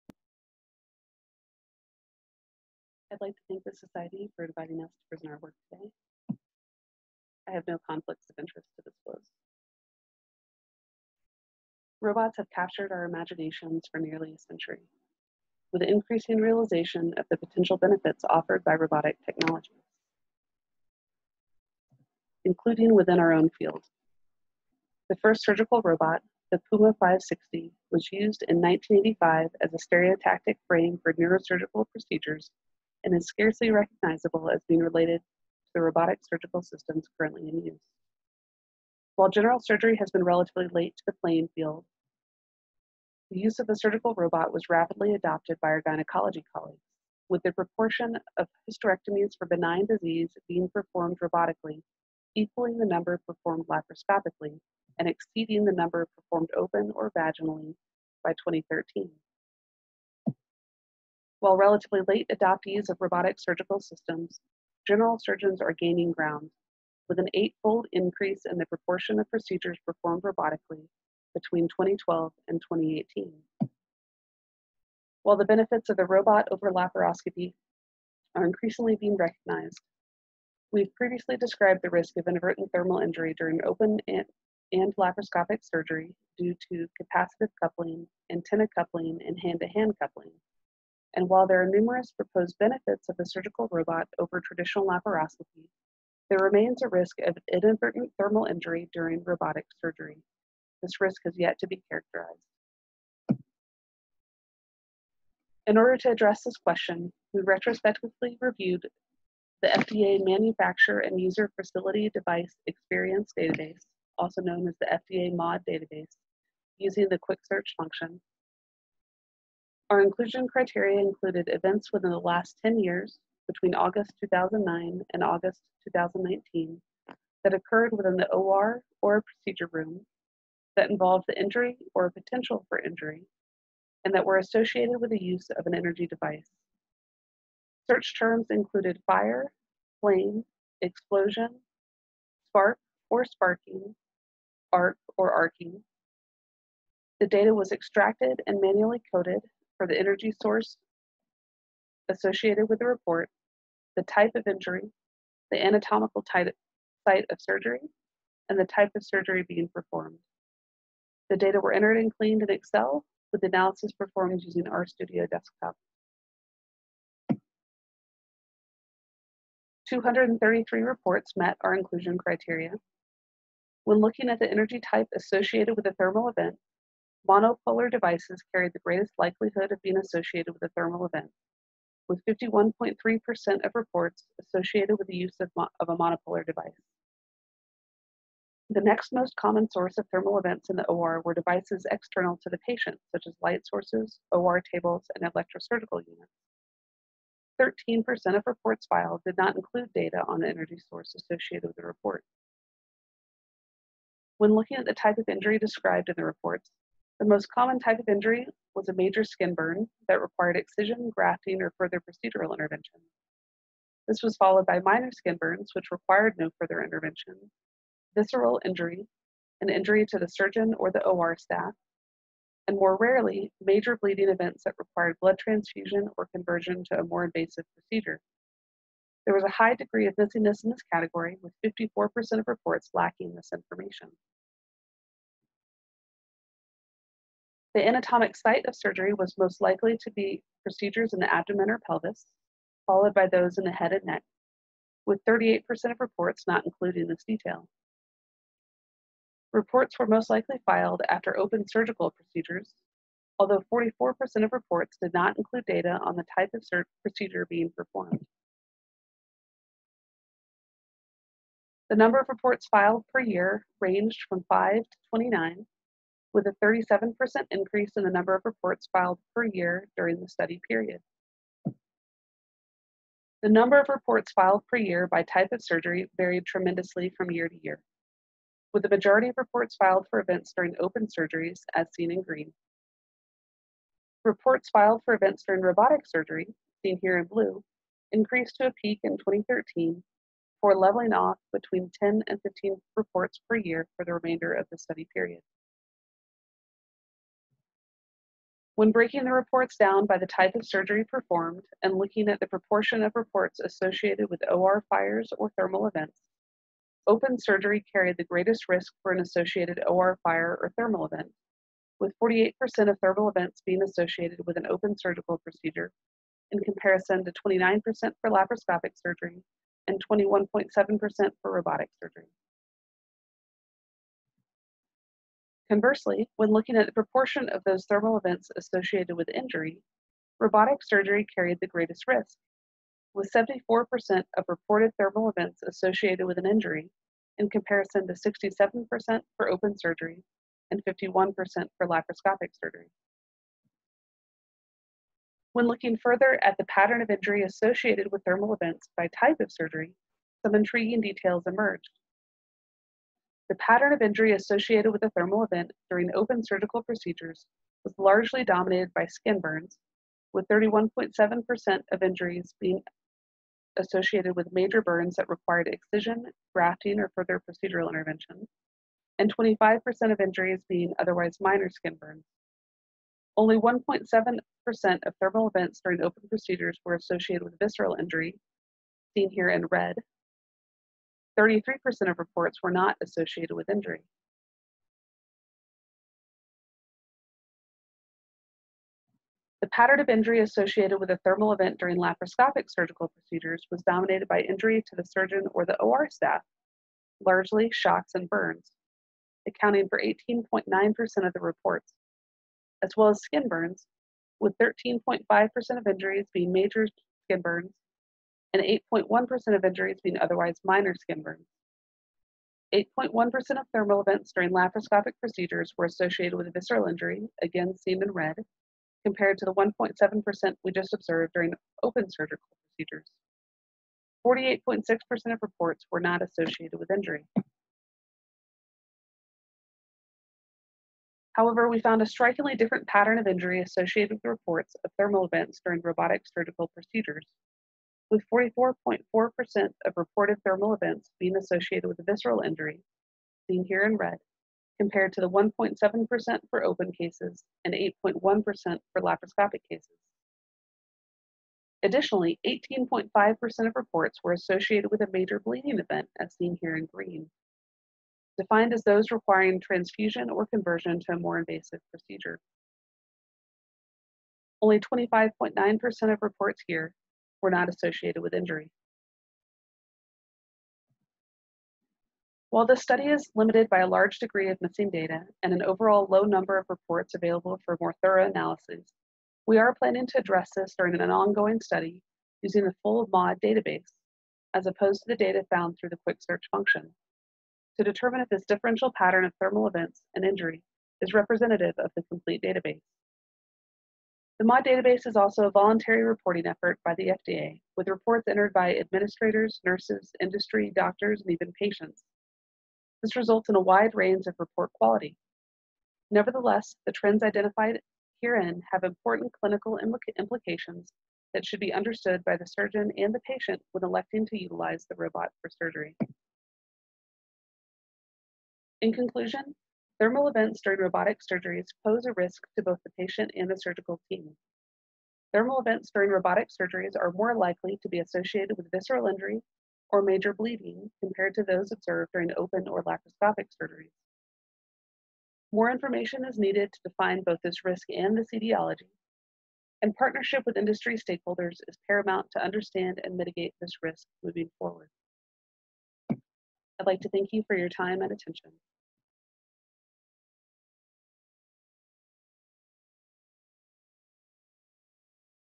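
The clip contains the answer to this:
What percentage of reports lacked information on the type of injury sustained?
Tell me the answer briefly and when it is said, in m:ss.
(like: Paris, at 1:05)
54%, at 3:51.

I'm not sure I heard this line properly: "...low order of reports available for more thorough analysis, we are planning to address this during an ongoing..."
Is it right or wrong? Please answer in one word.
wrong.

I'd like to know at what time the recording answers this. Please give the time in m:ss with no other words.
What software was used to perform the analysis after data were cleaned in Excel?
2:44.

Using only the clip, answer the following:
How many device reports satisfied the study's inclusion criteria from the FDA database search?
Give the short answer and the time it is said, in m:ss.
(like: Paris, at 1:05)
233, at 2:49.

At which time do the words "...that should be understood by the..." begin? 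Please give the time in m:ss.
8:31.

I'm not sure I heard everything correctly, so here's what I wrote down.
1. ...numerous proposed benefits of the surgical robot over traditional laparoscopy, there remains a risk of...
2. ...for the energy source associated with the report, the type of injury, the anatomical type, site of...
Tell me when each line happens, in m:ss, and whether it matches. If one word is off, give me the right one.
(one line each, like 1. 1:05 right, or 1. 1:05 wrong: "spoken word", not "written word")
1. 1:31 right
2. 2:29 right.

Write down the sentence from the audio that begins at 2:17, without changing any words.
Search terms included fire, flame, explosion, spark or sparking, arc or arcing.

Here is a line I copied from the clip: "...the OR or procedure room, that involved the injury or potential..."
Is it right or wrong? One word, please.
right.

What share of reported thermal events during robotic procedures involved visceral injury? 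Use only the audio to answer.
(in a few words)
44.4%.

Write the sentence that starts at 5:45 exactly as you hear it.
When looking further at the pattern of injury associated with thermal events by type of surgery, some intriguing details emerged.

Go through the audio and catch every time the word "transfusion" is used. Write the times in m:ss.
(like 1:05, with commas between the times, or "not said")
3:45, 7:39.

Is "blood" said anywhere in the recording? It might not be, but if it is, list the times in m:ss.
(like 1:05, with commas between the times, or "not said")
3:45.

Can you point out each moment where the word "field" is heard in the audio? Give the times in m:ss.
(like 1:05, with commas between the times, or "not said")
0:23, 0:41.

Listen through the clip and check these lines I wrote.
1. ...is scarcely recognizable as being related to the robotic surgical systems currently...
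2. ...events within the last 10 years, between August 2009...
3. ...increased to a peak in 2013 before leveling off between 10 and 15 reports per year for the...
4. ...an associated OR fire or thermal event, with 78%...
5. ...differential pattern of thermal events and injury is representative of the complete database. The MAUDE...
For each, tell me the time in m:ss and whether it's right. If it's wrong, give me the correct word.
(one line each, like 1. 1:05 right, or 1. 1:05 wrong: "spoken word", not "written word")
1. 0:33 right
2. 2:01 right
3. 4:48 right
4. 5:09 wrong: "48", not "78"
5. 8:08 right.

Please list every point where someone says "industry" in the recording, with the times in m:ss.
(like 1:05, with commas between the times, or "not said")
8:20, 9:00.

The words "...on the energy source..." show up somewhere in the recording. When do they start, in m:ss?
3:20.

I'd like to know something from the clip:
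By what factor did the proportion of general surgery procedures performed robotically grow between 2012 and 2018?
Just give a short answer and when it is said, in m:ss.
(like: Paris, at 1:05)
eightfold, at 1:07.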